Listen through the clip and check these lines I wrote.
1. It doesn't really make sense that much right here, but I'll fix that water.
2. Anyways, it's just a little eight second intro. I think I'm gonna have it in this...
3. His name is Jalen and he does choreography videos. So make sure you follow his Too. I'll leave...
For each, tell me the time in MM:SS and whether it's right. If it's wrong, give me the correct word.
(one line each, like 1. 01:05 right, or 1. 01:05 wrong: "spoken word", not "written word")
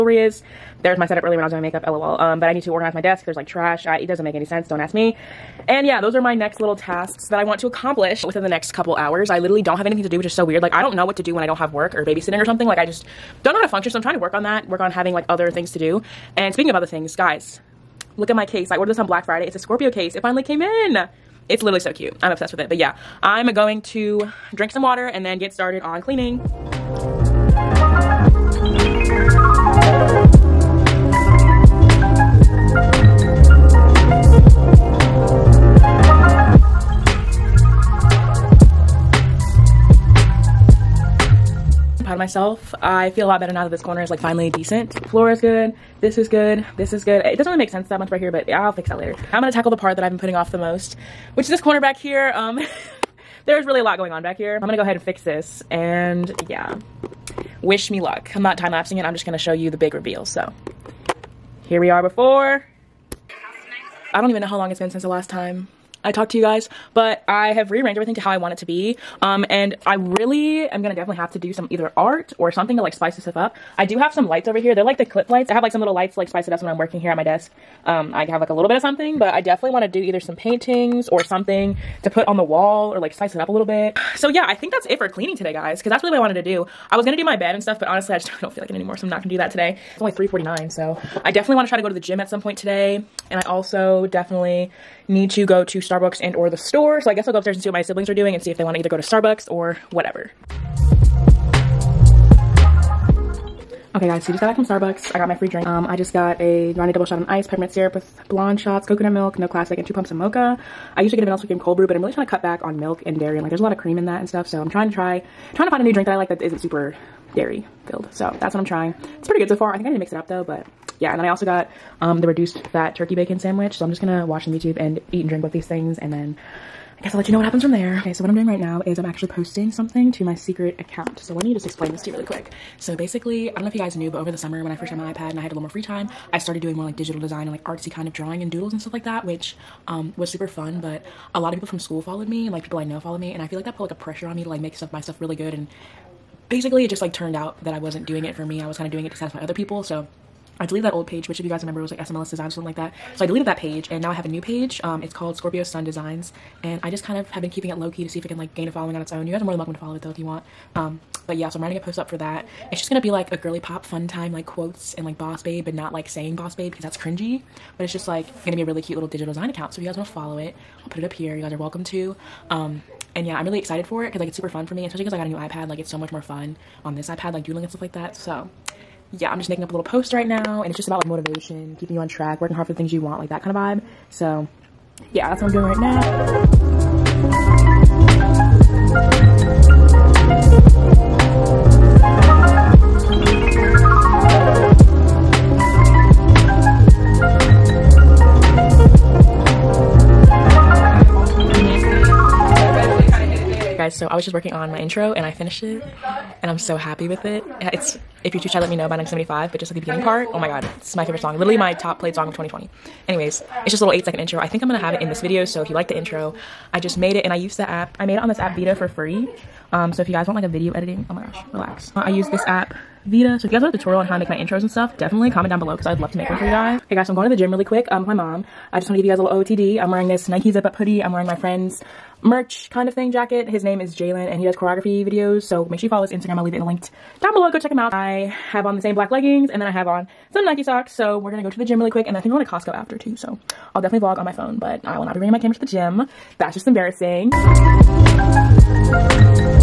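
1. 00:47 wrong: "later", not "water"
2. 03:33 right
3. 03:53 wrong: "Instagram", not "Too".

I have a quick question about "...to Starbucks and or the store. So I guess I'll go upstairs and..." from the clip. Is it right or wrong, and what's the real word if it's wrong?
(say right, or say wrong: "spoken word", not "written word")
right.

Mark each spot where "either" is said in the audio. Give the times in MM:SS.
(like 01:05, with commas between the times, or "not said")
01:11, 01:19, 01:38.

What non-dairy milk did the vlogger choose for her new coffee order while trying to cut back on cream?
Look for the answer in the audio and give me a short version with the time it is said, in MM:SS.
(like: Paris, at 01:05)
Coconut milk, at 01:48.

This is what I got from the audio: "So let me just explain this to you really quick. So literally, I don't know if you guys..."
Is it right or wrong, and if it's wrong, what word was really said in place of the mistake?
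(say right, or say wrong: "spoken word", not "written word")
wrong: "basically", not "literally".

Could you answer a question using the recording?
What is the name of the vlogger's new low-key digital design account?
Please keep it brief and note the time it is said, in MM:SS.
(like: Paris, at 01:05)
Scorpio Sun Designs, at 02:35.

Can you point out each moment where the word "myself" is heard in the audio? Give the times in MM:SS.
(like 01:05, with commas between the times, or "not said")
00:42.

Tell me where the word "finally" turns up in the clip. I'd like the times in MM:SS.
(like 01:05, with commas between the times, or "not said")
00:20, 00:44.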